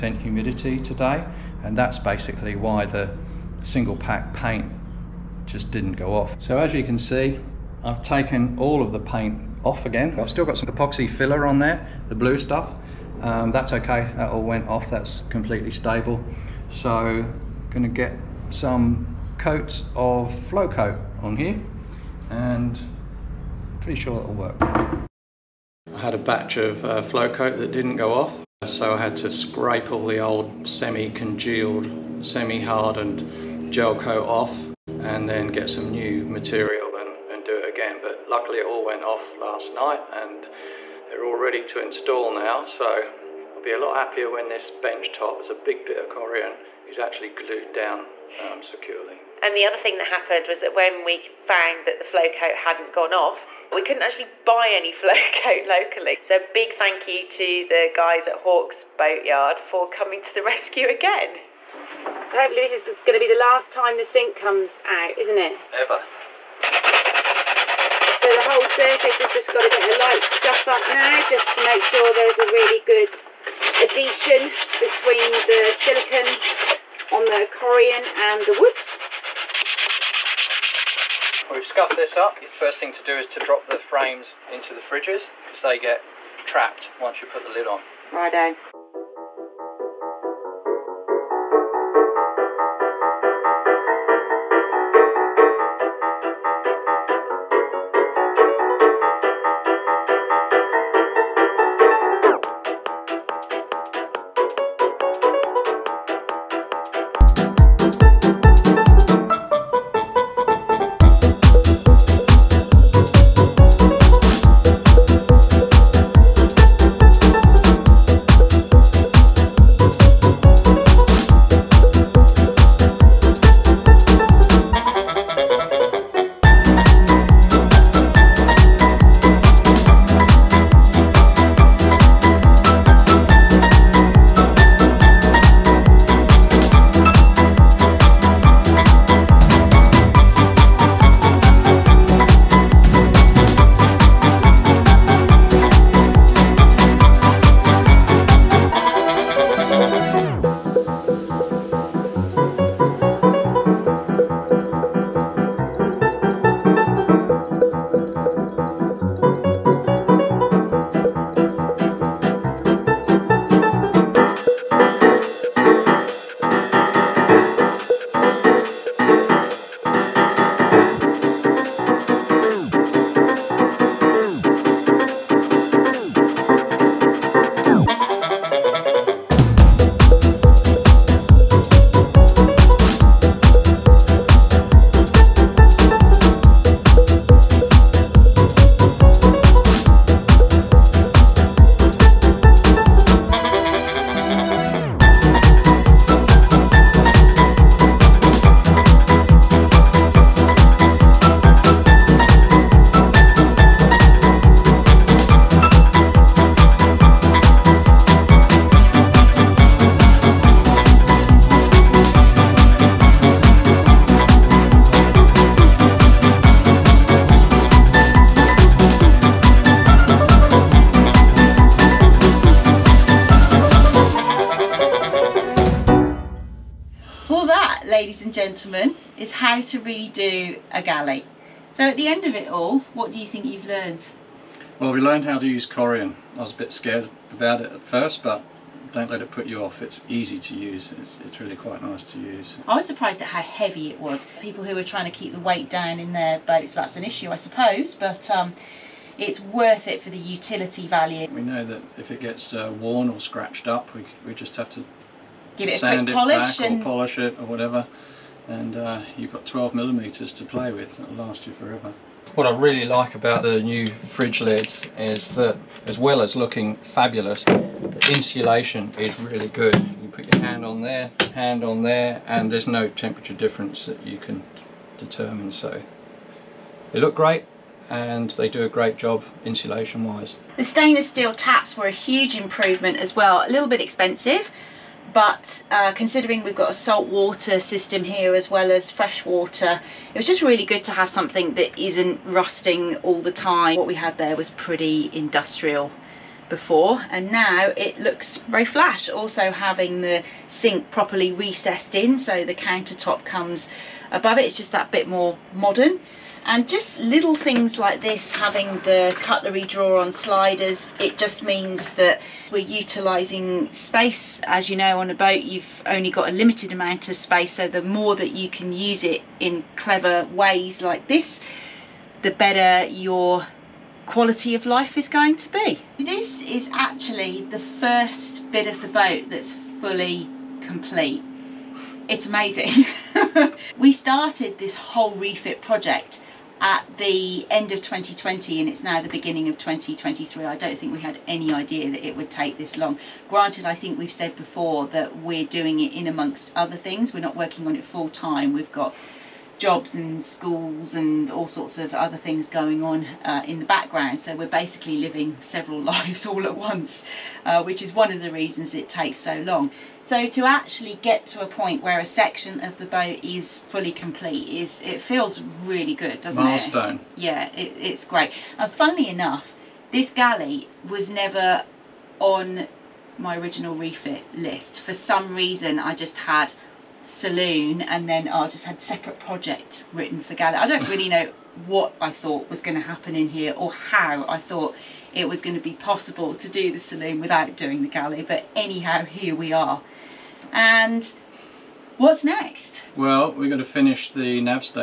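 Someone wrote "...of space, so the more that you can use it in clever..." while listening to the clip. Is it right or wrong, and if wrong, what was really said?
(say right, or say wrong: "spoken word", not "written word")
right.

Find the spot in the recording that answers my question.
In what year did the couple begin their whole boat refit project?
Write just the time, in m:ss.
5:37.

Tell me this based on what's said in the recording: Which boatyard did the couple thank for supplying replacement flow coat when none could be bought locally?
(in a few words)
Hawkes Boatyard.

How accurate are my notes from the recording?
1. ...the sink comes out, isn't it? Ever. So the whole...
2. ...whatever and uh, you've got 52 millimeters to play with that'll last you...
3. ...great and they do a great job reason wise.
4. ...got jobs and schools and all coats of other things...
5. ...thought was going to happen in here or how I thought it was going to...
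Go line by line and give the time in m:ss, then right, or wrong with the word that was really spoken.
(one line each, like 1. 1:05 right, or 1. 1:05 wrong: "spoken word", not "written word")
1. 1:03 right
2. 4:17 wrong: "12", not "52"
3. 4:37 wrong: "insulation", not "reason"
4. 5:48 wrong: "sorts", not "coats"
5. 6:22 right.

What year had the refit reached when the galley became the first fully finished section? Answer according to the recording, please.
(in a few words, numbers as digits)
2023.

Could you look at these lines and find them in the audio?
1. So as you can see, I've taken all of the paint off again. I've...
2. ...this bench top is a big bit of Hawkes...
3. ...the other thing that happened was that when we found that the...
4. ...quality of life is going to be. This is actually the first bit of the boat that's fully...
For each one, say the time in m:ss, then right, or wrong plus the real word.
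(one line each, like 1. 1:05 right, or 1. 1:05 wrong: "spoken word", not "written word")
1. 0:06 right
2. 0:44 wrong: "Corian", not "Hawkes"
3. 0:49 right
4. 5:24 right.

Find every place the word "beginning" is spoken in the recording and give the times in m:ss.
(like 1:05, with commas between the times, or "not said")
5:39.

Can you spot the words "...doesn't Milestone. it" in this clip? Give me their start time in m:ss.
6:06.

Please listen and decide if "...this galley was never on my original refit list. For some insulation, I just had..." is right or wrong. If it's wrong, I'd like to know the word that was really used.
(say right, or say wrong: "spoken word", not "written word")
wrong: "reason", not "insulation".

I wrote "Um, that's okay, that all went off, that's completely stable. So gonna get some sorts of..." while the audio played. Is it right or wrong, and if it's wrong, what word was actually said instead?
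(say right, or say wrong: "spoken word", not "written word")
wrong: "coats", not "sorts".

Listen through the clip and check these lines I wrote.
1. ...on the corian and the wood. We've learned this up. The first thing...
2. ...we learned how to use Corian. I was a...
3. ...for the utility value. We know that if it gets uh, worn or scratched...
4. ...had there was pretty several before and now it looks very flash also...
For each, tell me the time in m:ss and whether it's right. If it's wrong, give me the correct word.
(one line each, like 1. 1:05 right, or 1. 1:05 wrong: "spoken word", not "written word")
1. 1:17 wrong: "scuffed", not "learned"
2. 3:54 right
3. 4:09 right
4. 4:53 wrong: "industrial", not "several".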